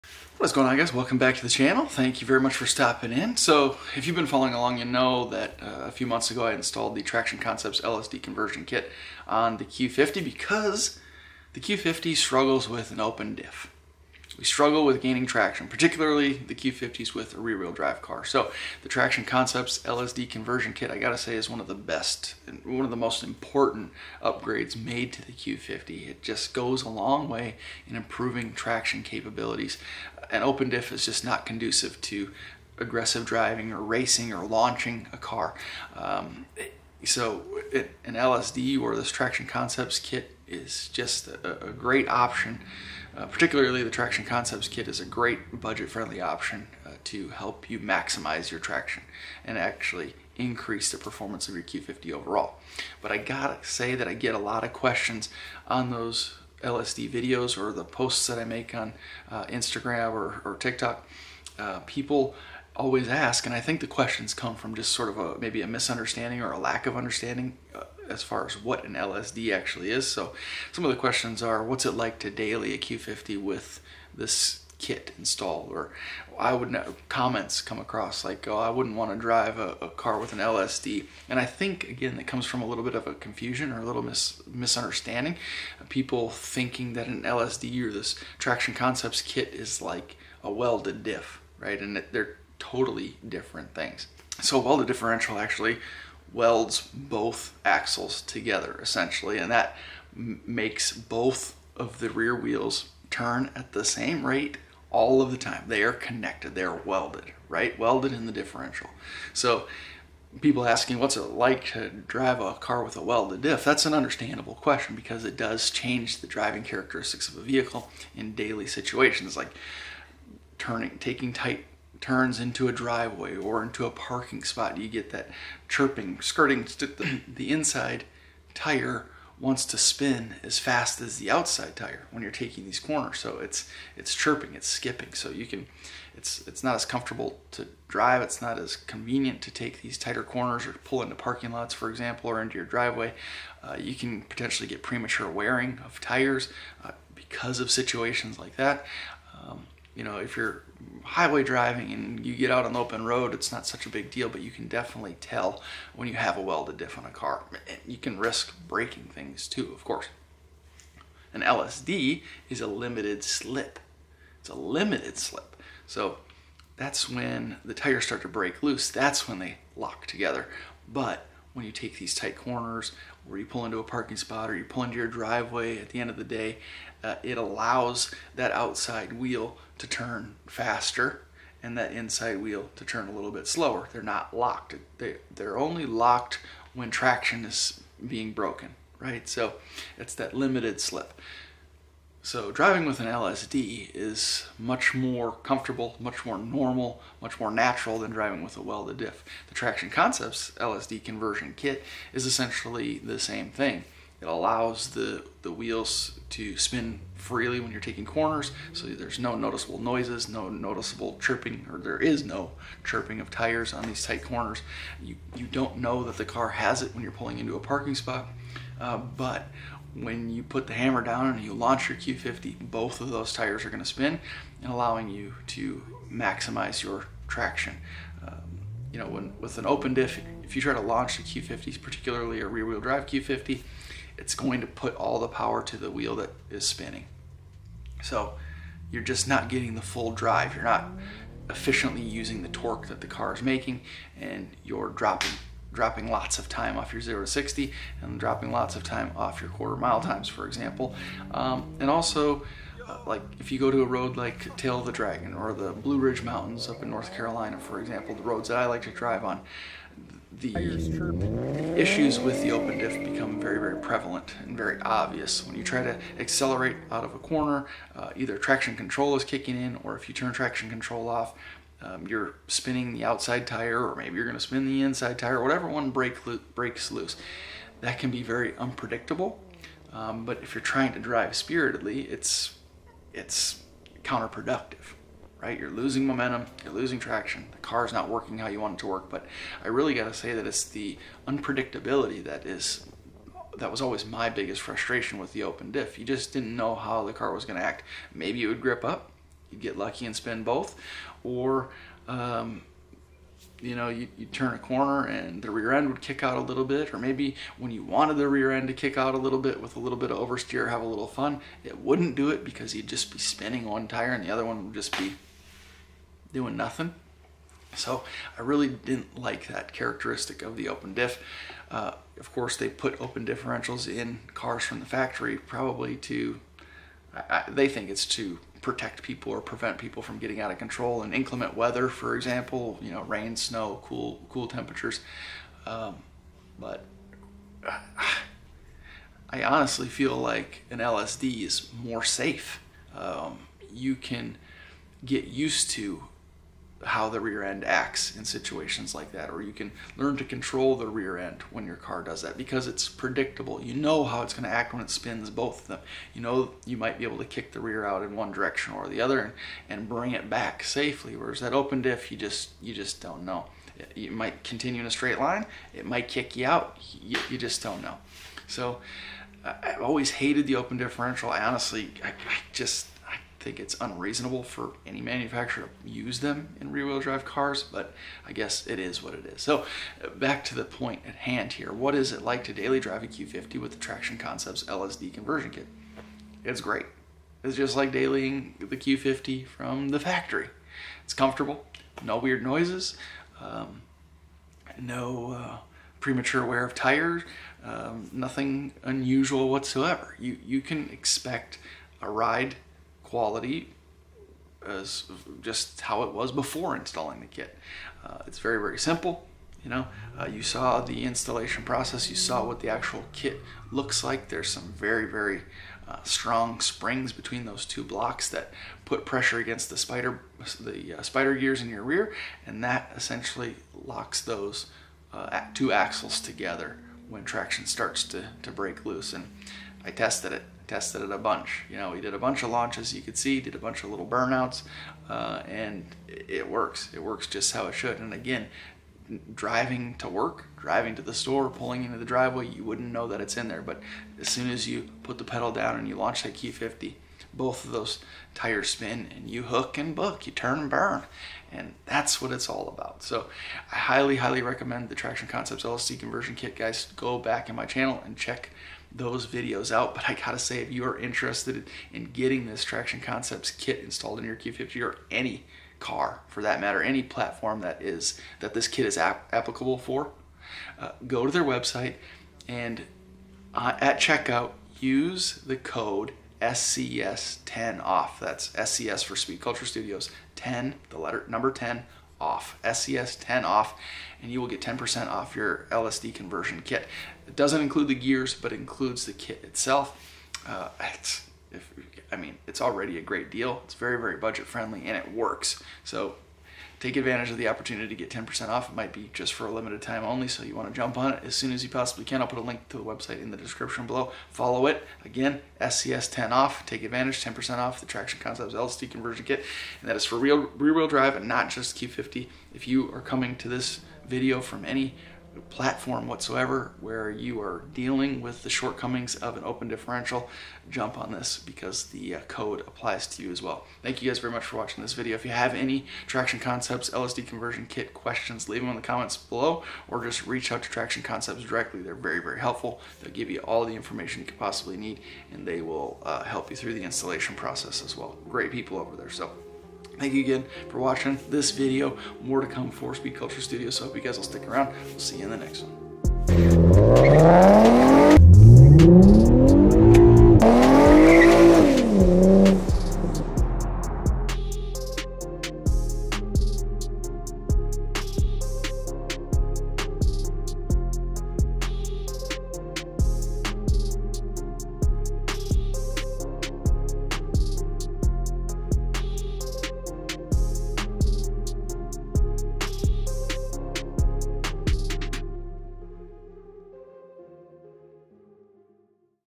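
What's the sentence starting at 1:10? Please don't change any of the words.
So some of the questions are, what's it like to daily a Q50 with this kit installed?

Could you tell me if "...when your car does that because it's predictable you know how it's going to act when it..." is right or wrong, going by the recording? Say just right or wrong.
right.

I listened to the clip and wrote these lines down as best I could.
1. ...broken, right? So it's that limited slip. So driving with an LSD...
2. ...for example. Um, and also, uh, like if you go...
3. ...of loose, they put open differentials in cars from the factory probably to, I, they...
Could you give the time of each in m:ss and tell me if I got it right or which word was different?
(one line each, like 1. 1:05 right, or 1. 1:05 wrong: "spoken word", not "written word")
1. 3:08 right
2. 4:10 right
3. 5:22 wrong: "course", not "loose".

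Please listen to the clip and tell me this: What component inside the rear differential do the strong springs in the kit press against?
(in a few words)
spider gears.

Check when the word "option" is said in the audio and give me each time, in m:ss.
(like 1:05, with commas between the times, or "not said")
0:42, 0:46.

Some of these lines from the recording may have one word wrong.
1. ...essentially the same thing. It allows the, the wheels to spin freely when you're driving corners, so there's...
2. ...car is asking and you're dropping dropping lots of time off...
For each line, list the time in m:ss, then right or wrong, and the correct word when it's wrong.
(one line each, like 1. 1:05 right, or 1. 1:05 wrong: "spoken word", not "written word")
1. 3:22 wrong: "taking", not "driving"
2. 4:03 wrong: "making", not "asking".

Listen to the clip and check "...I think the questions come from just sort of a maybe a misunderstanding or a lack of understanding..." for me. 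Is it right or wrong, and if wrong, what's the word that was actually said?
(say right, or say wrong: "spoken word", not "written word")
right.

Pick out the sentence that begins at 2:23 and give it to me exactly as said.
Uh, you can potentially get premature wearing of tires uh, because of situations like that.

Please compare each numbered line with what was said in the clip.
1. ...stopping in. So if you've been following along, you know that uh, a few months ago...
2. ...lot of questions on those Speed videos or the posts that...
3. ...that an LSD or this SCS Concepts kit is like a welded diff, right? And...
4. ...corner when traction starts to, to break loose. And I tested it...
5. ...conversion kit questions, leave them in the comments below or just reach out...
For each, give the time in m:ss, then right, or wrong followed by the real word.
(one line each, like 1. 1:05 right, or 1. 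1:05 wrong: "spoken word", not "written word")
1. 0:02 right
2. 0:54 wrong: "LSD", not "Speed"
3. 1:26 wrong: "Traction", not "SCS"
4. 7:06 wrong: "together", not "corner"
5. 8:47 right.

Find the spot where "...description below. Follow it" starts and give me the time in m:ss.
8:23.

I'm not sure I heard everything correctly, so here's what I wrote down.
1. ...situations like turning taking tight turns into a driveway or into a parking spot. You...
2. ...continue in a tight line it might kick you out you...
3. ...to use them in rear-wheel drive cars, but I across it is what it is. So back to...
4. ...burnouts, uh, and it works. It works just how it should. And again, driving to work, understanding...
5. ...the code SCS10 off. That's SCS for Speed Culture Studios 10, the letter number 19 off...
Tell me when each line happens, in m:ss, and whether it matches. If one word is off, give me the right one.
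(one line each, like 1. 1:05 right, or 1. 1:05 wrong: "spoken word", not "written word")
1. 1:58 right
2. 6:04 wrong: "straight", not "tight"
3. 6:15 wrong: "guess", not "across"
4. 7:14 wrong: "driving", not "understanding"
5. 7:55 wrong: "10", not "19".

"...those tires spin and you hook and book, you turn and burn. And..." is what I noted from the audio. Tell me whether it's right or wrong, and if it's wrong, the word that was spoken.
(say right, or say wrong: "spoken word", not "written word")
right.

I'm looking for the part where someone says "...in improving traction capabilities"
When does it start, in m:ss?
0:27.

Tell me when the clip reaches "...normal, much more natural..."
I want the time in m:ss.
3:16.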